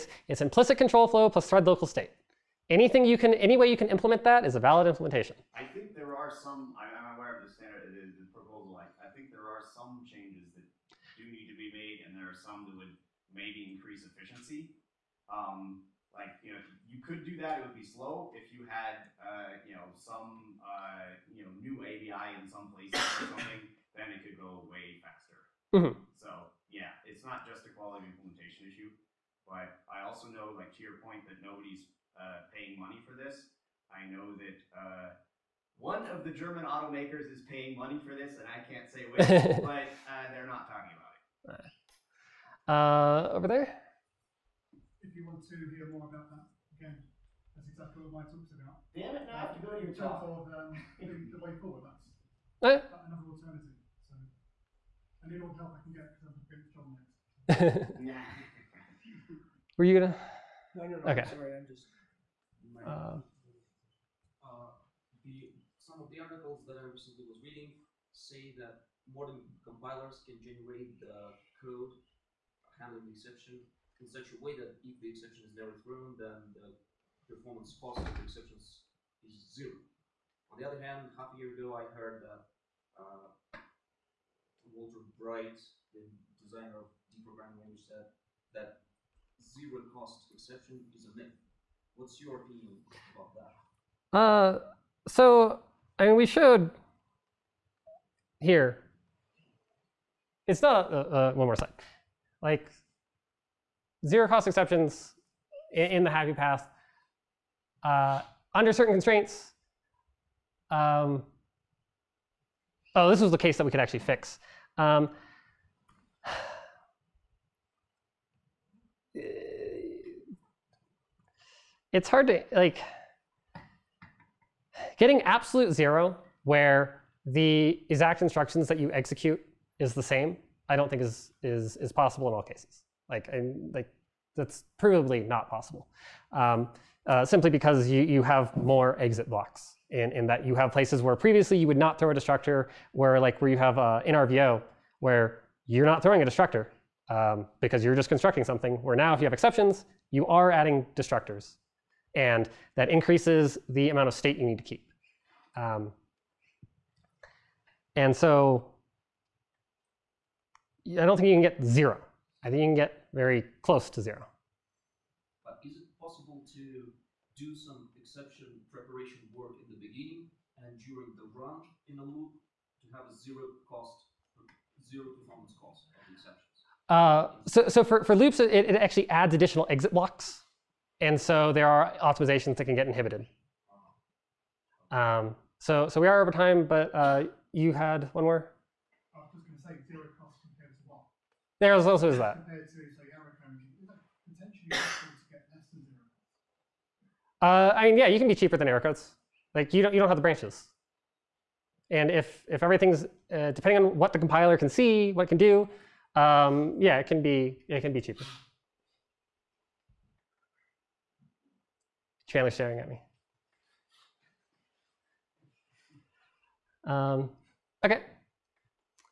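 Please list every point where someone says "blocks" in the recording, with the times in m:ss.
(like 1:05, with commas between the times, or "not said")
2:19, 2:59.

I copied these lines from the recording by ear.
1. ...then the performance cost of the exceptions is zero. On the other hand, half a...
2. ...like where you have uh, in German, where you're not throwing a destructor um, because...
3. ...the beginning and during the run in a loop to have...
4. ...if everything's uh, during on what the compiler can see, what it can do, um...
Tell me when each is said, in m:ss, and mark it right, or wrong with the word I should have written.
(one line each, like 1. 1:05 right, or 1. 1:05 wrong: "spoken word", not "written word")
1. 1:16 right
2. 2:23 wrong: "RVO", not "German"
3. 2:49 right
4. 3:22 wrong: "depending", not "during".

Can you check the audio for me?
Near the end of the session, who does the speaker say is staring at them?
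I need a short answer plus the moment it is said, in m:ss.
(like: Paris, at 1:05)
Chandler, at 3:32.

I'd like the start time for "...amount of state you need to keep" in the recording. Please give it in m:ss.
2:33.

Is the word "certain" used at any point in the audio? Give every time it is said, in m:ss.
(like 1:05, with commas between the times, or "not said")
1:48.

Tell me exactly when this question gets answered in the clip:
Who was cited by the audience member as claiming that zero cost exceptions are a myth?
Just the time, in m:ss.
1:24.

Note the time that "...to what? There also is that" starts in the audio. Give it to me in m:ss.
3:10.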